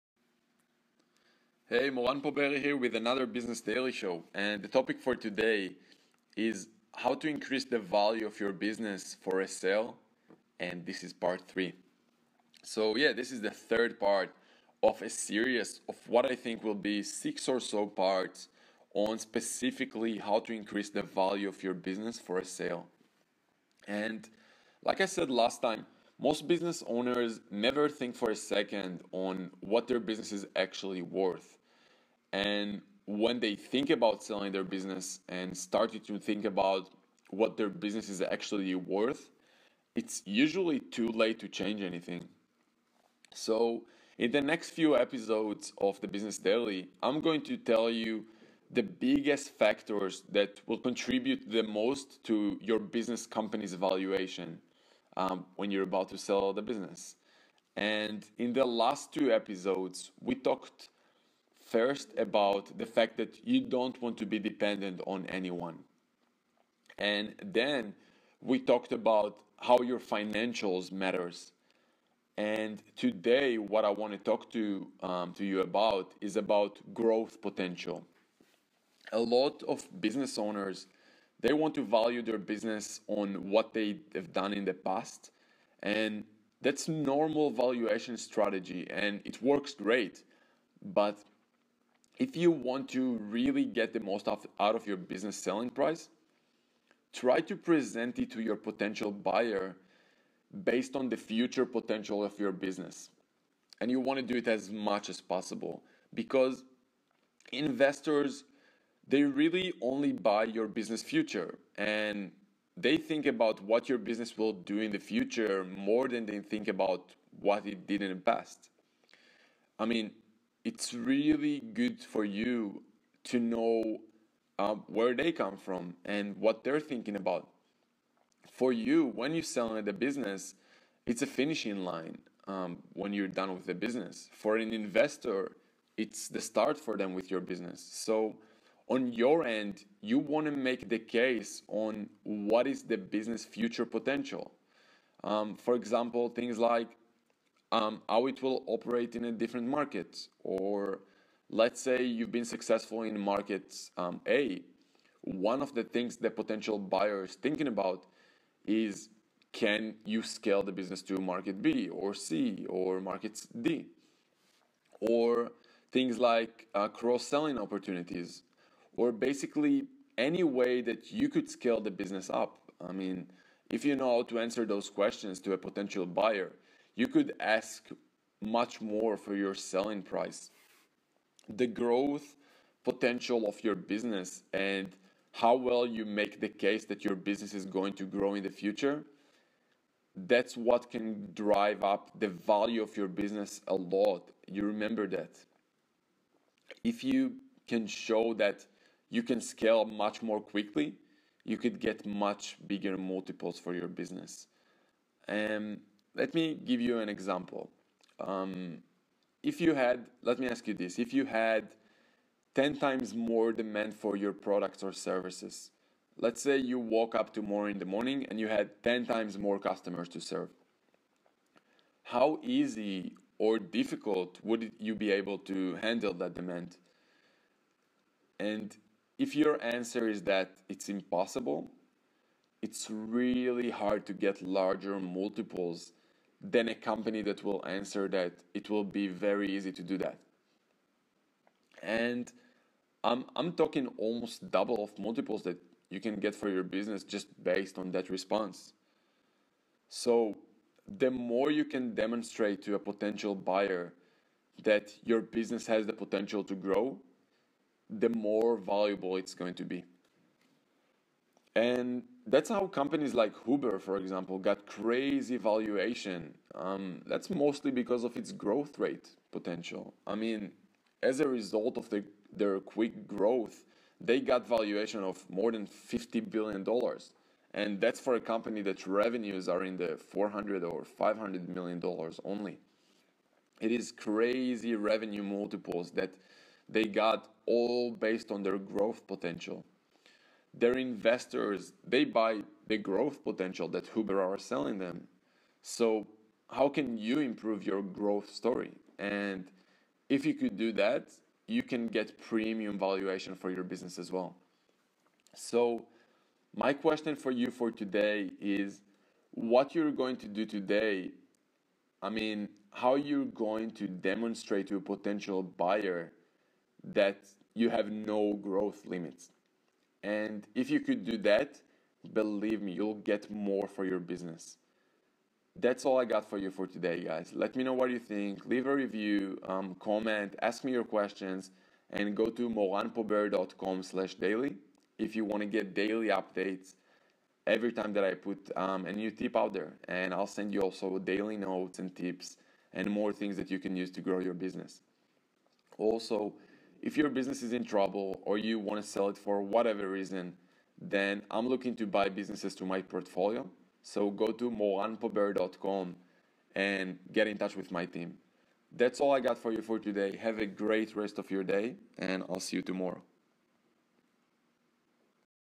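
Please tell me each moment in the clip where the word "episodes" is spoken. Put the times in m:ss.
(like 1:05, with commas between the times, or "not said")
0:44, 0:59.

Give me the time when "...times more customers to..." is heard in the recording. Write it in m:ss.
3:39.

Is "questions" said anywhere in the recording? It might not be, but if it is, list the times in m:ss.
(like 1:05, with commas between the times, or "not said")
2:54, 5:06, 5:30.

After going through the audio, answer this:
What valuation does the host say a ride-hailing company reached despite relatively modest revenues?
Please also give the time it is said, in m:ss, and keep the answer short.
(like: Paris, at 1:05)
More than $50 billion, at 4:35.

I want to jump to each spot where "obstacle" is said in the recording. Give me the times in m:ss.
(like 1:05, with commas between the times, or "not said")
not said.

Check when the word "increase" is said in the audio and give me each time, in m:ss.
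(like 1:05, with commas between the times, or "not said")
0:07, 0:20.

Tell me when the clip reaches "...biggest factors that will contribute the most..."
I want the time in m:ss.
0:48.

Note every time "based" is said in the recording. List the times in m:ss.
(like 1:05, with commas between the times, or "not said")
1:40, 4:07, 4:47.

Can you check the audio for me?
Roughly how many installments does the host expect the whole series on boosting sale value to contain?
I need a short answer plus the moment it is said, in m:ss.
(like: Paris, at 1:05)
6, at 0:17.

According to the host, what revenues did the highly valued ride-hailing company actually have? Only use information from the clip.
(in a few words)
$400–500 million.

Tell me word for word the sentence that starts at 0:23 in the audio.
And like I said last time, most business owners never think for a second on what their business is actually worth.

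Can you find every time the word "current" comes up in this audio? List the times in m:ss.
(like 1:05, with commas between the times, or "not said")
not said.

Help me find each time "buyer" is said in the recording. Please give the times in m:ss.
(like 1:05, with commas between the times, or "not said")
1:39, 2:36, 2:56, 4:13, 5:15.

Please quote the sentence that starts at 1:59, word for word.
I mean, it's really good for you to know uh, where they come from and what they're thinking about.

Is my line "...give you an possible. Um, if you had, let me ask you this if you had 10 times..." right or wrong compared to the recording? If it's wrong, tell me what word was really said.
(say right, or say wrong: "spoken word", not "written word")
wrong: "example", not "possible".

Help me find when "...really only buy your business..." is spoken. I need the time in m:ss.
1:49.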